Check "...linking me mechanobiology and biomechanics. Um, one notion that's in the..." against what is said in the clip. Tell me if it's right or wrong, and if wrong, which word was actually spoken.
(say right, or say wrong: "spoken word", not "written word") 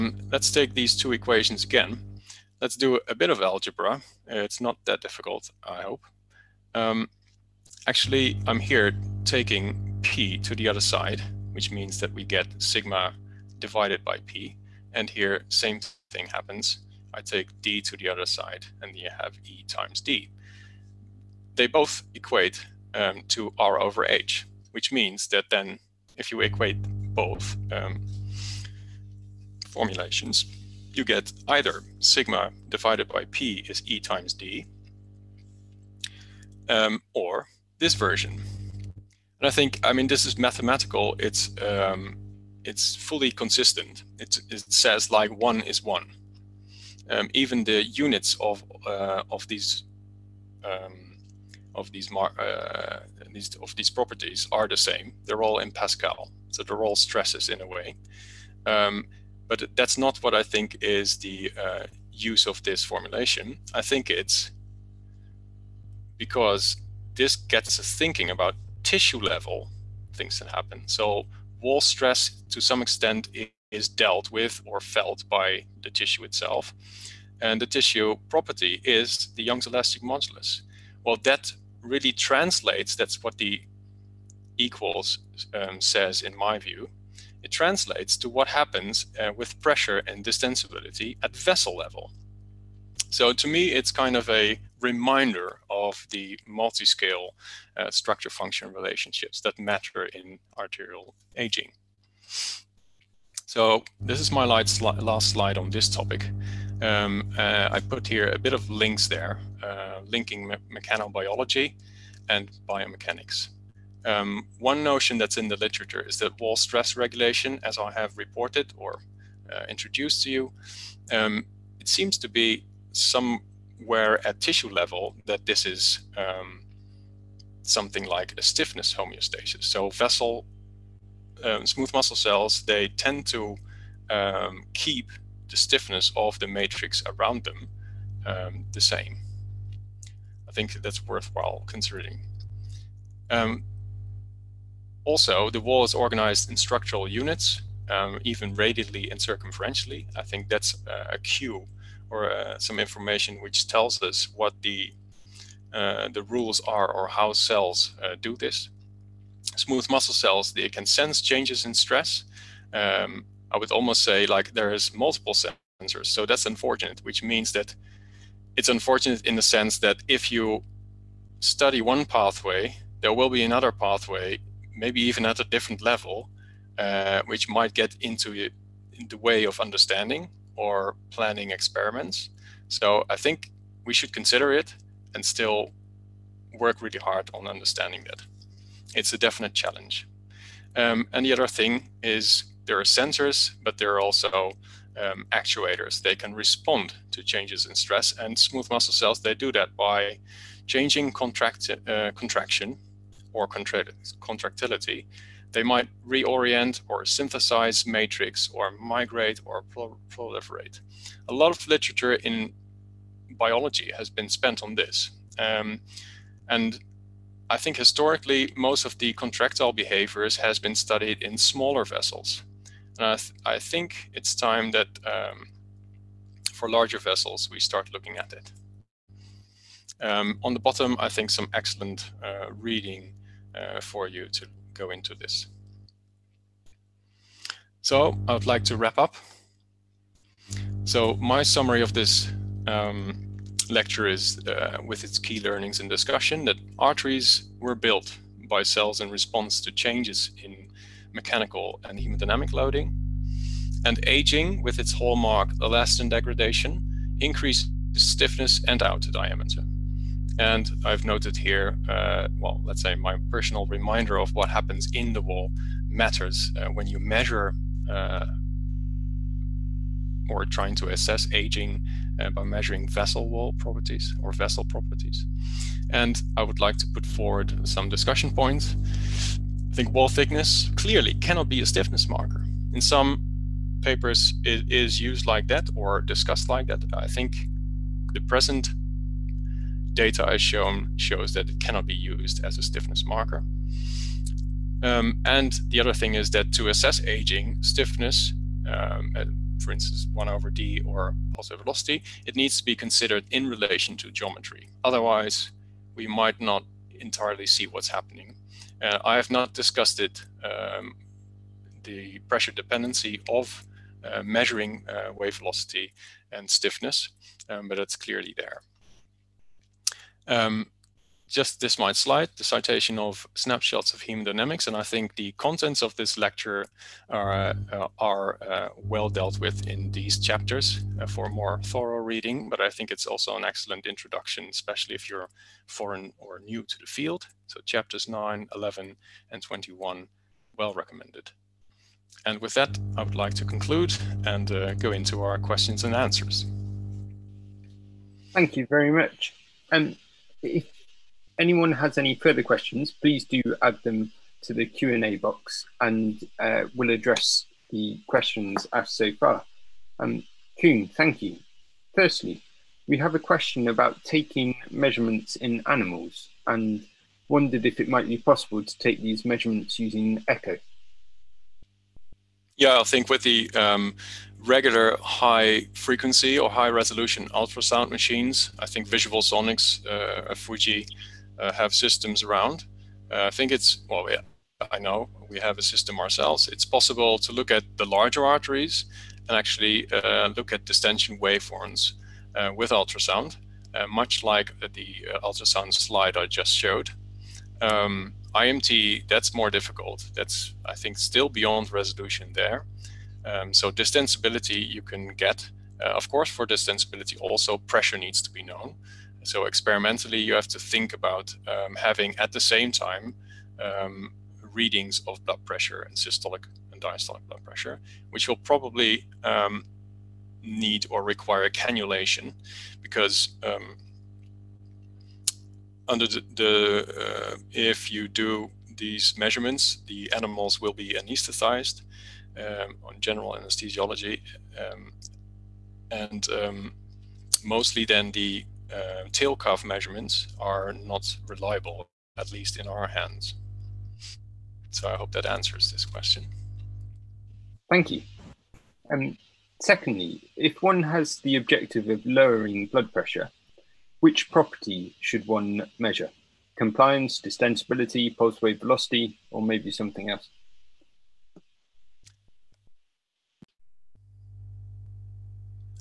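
right.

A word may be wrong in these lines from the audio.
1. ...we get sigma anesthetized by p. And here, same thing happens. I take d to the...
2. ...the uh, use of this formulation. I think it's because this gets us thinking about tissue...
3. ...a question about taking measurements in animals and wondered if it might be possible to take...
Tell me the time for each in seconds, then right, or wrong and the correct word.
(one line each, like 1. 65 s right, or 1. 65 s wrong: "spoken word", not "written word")
1. 12 s wrong: "divided", not "anesthetized"
2. 61 s right
3. 363 s right.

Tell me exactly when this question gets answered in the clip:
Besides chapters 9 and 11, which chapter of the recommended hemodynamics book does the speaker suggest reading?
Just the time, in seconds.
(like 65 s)
339 s.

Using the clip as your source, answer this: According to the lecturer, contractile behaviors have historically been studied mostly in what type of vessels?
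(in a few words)
smaller vessels.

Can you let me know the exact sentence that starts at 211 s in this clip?
A lot of literature in biology has been spent on this.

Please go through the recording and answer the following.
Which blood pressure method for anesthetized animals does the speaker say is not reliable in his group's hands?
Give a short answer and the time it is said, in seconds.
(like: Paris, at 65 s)
tail cuff measurements, at 439 s.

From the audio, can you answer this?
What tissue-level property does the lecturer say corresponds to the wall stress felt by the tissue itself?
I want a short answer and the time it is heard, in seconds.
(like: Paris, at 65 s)
Young's elastic modulus, at 79 s.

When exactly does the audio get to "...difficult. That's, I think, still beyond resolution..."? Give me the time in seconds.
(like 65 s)
399 s.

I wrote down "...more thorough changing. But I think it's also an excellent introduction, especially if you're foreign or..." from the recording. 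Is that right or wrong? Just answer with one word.
wrong.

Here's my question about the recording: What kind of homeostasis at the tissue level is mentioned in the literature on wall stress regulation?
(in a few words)
stiffness homeostasis.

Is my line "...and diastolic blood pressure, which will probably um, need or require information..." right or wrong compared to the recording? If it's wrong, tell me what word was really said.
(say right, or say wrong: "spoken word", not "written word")
wrong: "cannulation", not "information".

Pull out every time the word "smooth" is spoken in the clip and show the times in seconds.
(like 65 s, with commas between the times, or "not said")
131 s, 159 s, 198 s.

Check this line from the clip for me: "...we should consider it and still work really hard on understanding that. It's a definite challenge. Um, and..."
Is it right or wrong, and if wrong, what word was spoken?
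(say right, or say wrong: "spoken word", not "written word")
right.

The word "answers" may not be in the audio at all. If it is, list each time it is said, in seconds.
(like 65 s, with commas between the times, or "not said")
345 s, 445 s.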